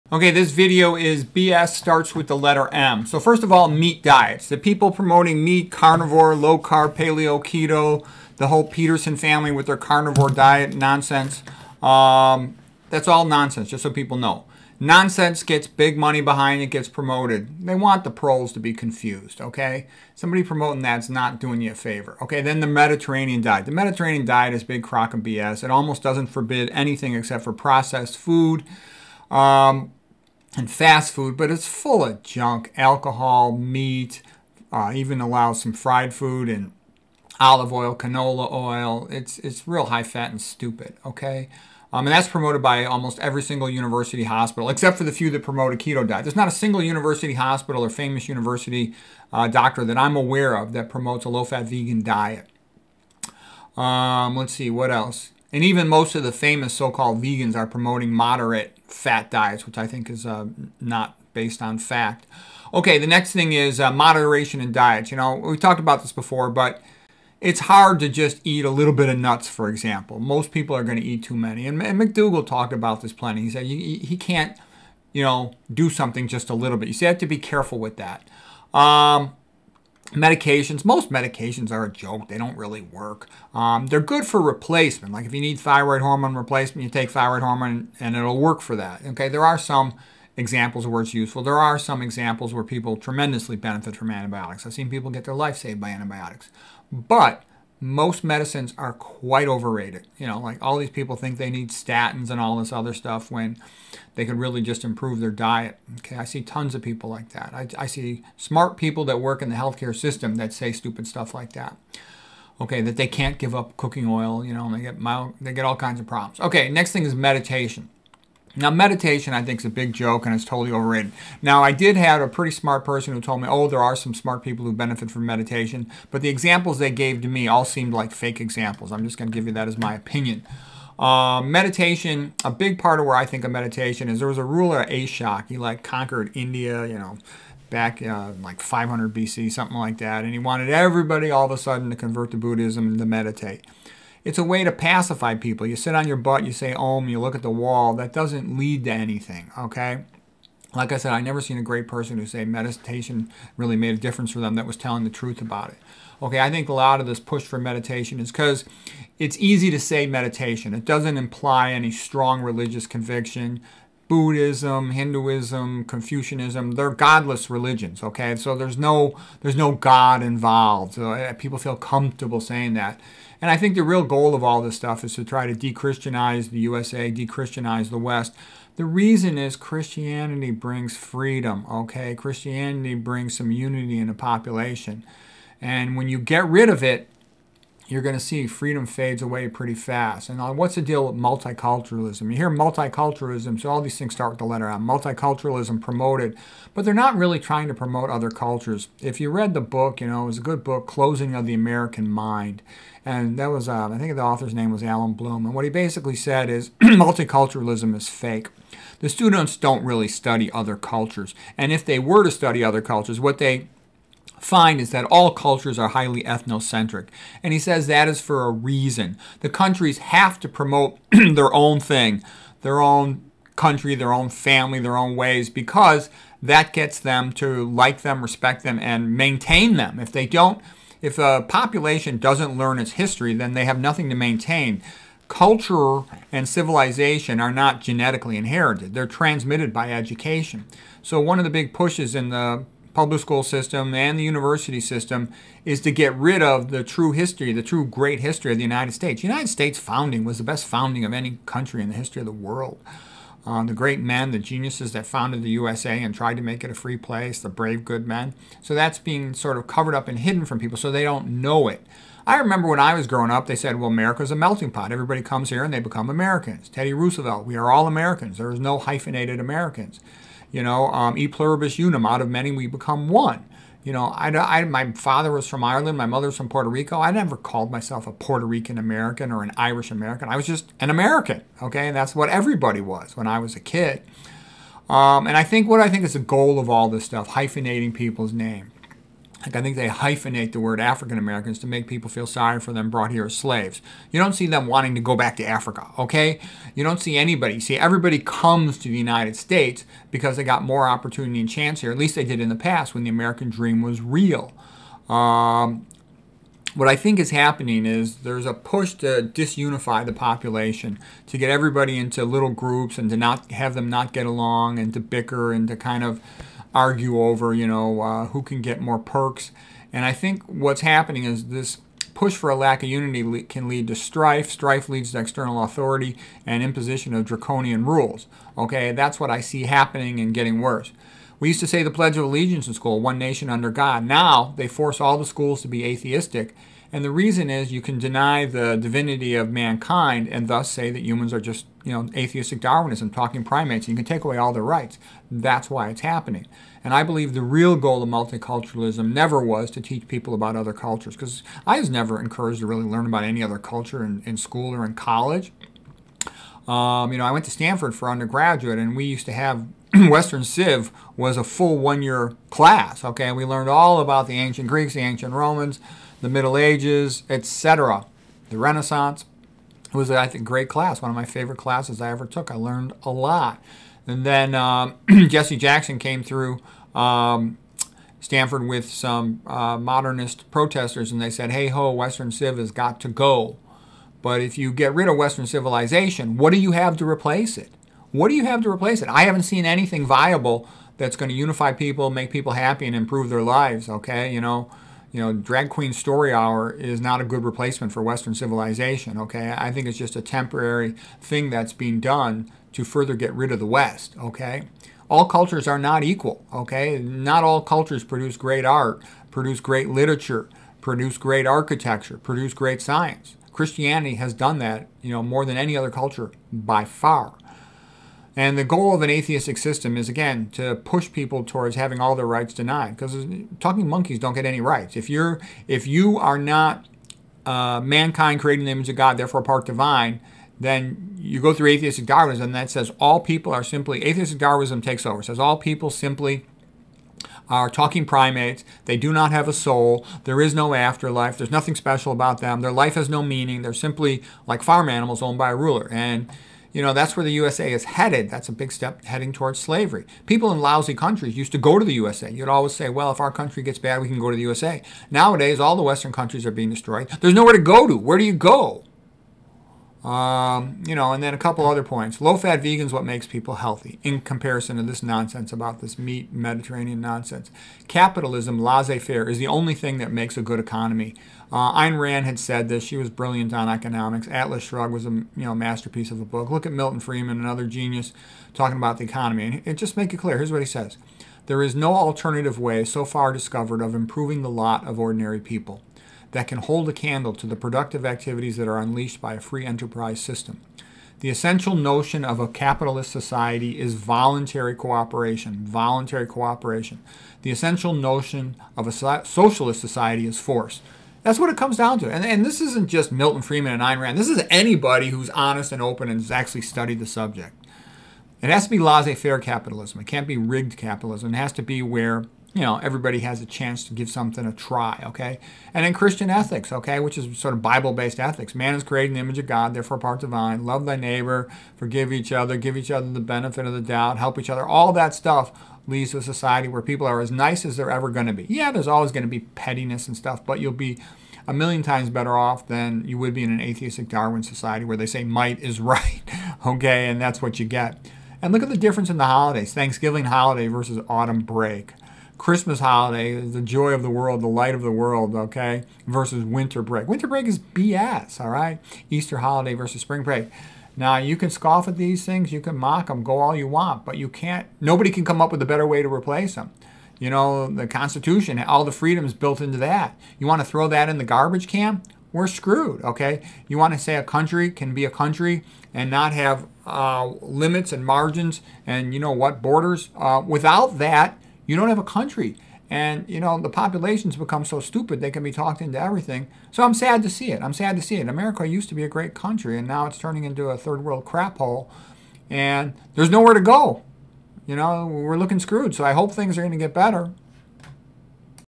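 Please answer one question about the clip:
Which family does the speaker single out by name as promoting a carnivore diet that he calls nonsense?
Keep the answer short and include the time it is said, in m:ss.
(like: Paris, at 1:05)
Peterson, at 0:08.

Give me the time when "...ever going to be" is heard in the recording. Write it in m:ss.
8:47.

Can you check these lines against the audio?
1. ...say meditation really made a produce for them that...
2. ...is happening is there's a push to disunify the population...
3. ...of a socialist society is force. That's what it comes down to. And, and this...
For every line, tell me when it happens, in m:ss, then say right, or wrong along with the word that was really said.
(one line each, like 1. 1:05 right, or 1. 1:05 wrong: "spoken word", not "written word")
1. 2:32 wrong: "difference", not "produce"
2. 5:07 right
3. 8:18 right.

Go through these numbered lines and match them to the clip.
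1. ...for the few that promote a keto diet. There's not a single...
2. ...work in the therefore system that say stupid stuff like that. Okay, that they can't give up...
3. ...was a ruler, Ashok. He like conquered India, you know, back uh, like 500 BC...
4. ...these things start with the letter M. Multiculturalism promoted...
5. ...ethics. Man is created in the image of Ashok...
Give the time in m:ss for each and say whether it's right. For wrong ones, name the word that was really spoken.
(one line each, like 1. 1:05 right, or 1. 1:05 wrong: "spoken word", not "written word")
1. 0:44 right
2. 1:49 wrong: "healthcare", not "therefore"
3. 2:14 right
4. 3:13 right
5. 8:38 wrong: "God", not "Ashok".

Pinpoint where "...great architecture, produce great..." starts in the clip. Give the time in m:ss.
6:51.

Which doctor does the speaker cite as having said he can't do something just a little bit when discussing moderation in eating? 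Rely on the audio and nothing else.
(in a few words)
McDougall.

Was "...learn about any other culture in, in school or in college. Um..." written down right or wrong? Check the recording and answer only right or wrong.
right.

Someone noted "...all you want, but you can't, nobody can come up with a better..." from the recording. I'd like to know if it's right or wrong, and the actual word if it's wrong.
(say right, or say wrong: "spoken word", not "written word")
right.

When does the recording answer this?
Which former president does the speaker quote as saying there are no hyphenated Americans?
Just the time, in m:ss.
4:26.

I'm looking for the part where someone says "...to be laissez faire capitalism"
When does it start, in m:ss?
8:28.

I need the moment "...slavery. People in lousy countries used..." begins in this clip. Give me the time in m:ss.
7:29.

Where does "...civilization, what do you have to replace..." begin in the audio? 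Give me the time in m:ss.
6:25.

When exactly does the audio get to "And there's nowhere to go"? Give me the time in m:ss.
9:42.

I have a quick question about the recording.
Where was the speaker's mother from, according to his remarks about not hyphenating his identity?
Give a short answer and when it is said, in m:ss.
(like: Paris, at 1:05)
Puerto Rico, at 4:36.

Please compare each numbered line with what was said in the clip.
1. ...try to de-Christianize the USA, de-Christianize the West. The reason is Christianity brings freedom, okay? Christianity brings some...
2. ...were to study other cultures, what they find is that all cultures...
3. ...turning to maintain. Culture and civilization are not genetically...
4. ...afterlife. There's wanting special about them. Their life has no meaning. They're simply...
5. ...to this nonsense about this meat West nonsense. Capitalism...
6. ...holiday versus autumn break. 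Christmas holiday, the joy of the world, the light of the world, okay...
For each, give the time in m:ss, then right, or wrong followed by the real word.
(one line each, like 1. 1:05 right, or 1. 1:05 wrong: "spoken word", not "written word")
1. 2:55 right
2. 3:31 right
3. 3:53 wrong: "nothing", not "turning"
4. 7:20 wrong: "nothing", not "wanting"
5. 7:44 wrong: "Mediterranean", not "West"
6. 9:00 right.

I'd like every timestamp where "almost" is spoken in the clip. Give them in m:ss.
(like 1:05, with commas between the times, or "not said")
0:25, 0:42.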